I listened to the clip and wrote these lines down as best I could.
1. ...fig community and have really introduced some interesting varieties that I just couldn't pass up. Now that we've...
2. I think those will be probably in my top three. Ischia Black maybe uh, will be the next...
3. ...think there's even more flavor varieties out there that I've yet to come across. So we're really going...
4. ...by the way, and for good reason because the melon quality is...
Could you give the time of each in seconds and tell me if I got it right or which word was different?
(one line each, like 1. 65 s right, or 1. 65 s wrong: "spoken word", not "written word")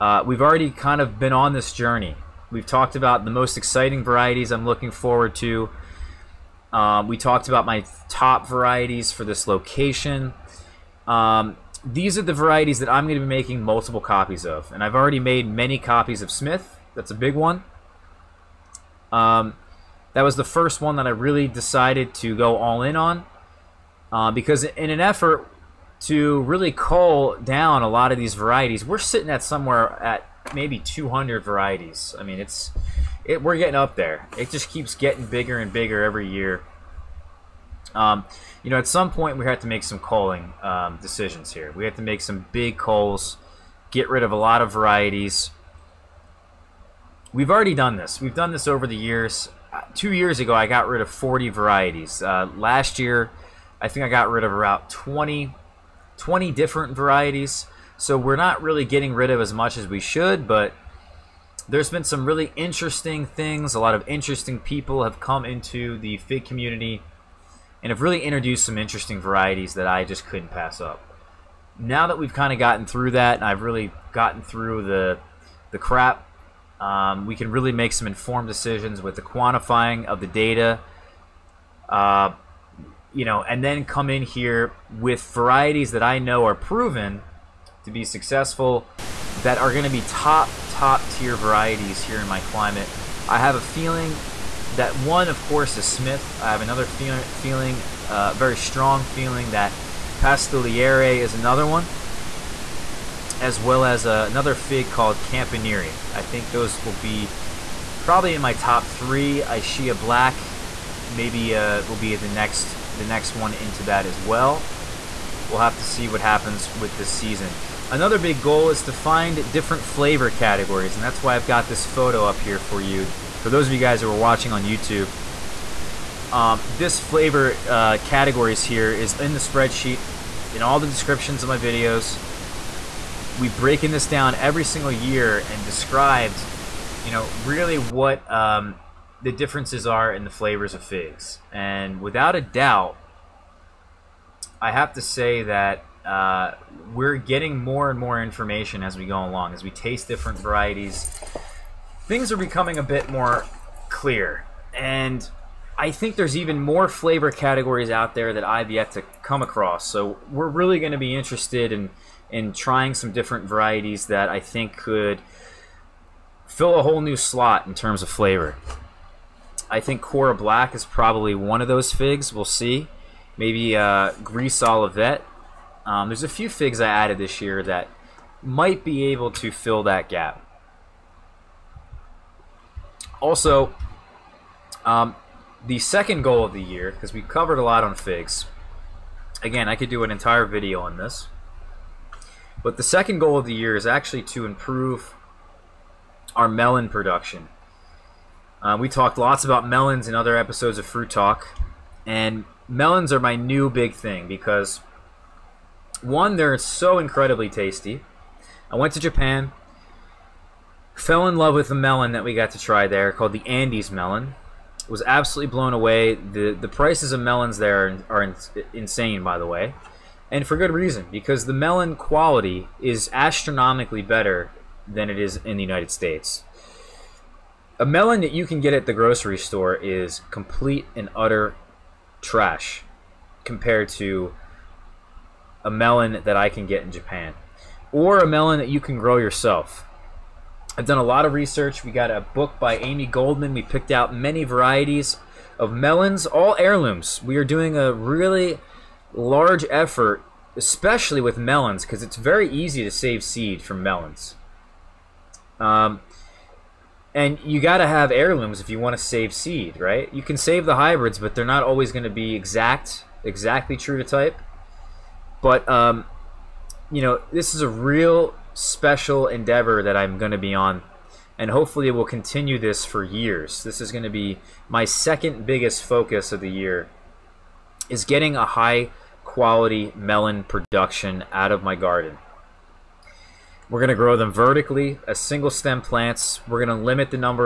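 1. 66 s right
2. 106 s right
3. 155 s wrong: "categories", not "varieties"
4. 219 s right.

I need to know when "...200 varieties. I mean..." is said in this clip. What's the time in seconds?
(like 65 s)
30 s.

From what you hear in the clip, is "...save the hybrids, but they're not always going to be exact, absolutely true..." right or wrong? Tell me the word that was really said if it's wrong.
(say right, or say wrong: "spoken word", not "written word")
wrong: "exactly", not "absolutely".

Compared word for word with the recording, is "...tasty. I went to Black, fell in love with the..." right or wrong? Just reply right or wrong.
wrong.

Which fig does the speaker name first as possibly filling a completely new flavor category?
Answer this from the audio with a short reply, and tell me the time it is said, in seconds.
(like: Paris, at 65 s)
Cora Black, at 170 s.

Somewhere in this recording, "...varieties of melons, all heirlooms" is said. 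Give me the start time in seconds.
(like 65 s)
244 s.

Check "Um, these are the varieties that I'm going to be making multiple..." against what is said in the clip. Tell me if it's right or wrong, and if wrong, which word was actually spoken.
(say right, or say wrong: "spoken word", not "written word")
right.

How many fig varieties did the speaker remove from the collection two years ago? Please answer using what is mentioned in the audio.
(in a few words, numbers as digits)
40.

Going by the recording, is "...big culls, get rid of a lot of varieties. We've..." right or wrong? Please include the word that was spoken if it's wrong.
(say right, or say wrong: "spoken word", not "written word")
right.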